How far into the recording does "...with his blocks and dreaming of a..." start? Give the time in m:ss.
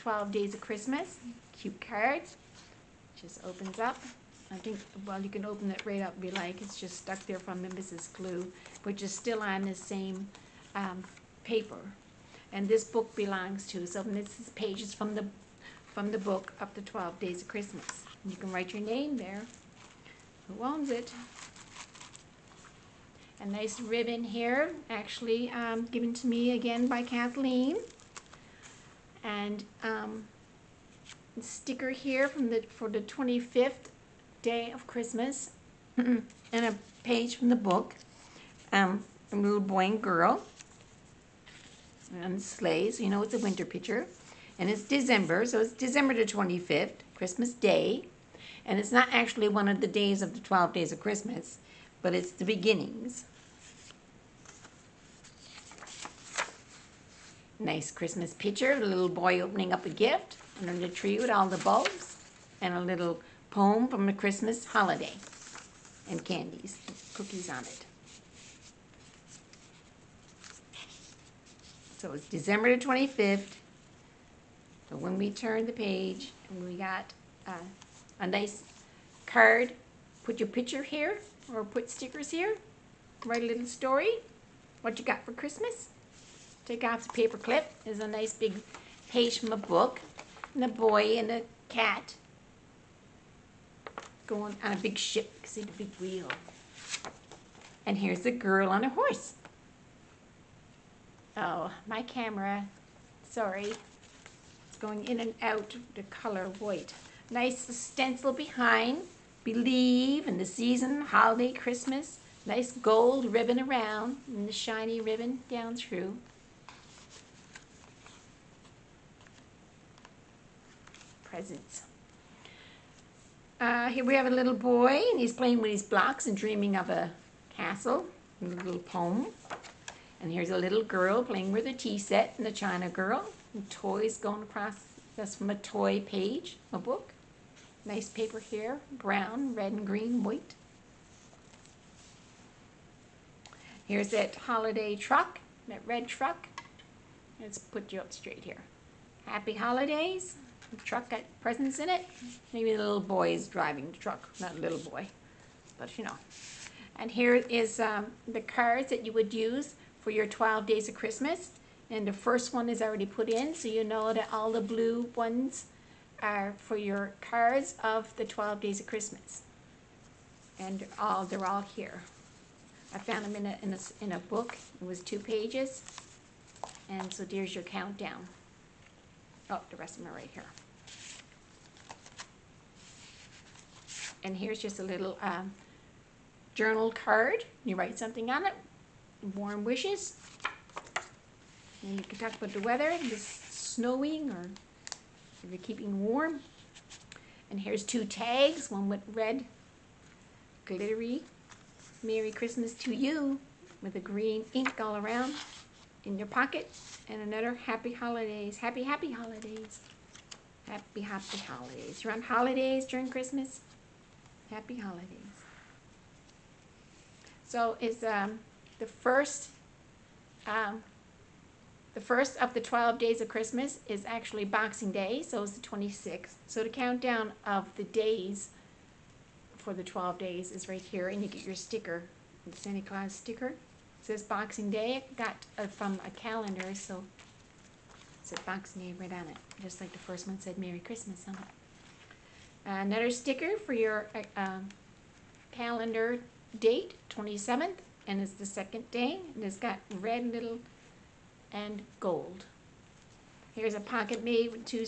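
2:05.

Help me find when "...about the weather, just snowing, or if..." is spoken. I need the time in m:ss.
3:12.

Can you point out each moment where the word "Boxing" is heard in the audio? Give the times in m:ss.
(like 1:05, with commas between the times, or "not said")
3:44, 3:54, 3:58.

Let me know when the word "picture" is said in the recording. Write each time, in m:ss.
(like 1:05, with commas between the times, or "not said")
0:43, 0:58, 1:20.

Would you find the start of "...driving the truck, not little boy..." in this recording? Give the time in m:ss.
2:33.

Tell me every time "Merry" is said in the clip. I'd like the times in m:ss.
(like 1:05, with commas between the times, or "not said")
3:22, 4:00.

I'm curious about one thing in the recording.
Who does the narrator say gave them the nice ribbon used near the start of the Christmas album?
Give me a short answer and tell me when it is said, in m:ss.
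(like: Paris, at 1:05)
Kathleen, at 0:27.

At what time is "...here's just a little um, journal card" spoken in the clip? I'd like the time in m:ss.
3:04.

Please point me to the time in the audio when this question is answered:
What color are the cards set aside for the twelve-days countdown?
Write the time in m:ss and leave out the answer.
2:44.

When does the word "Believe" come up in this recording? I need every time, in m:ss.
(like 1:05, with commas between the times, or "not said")
1:49.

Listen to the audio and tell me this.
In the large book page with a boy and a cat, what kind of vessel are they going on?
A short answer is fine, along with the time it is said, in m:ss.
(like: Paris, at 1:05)
A big ship, at 1:34.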